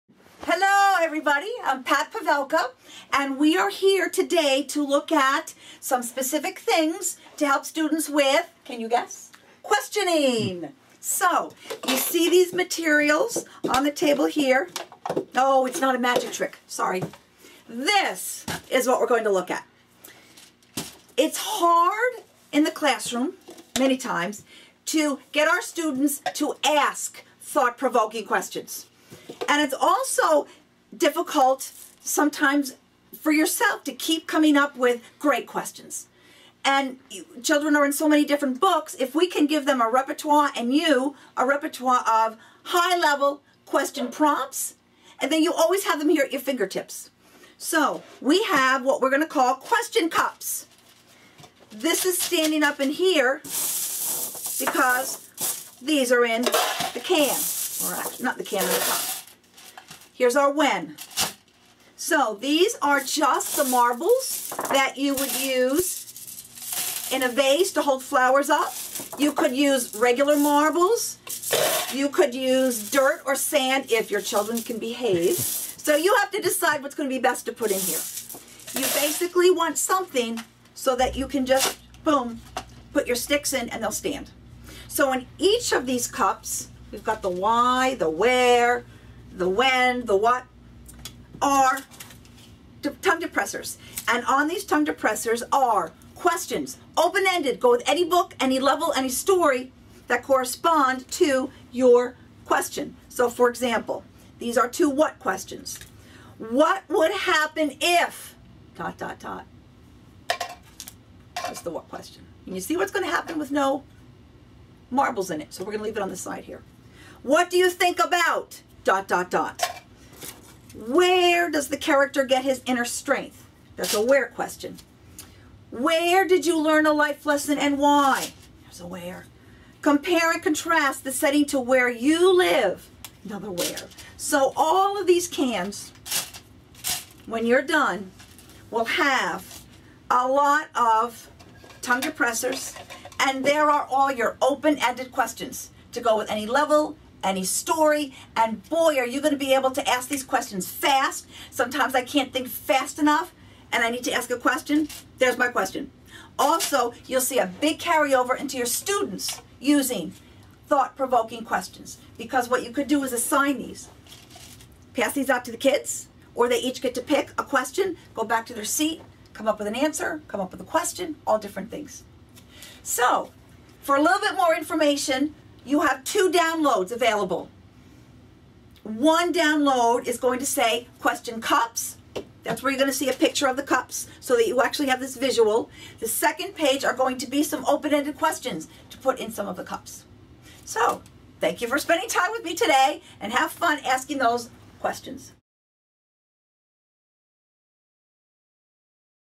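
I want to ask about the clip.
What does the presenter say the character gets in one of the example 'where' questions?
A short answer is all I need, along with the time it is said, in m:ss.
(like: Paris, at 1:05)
inner strength, at 2:02.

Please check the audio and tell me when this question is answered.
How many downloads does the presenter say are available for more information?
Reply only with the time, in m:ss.
2:56.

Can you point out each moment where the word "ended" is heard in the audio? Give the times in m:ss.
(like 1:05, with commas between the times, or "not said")
1:36, 2:24, 3:07.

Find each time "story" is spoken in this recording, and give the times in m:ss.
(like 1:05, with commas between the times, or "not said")
1:39, 2:27.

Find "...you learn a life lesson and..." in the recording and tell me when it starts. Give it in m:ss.
2:06.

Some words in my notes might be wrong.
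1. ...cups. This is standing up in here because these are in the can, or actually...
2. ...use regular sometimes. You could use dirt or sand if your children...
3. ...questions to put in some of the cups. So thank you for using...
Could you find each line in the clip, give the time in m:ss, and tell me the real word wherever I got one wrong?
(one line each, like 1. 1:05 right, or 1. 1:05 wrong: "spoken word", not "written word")
1. 0:50 right
2. 1:09 wrong: "marbles", not "sometimes"
3. 3:08 wrong: "spending", not "using".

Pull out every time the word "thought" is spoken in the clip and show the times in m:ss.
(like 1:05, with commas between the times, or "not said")
0:27, 2:40.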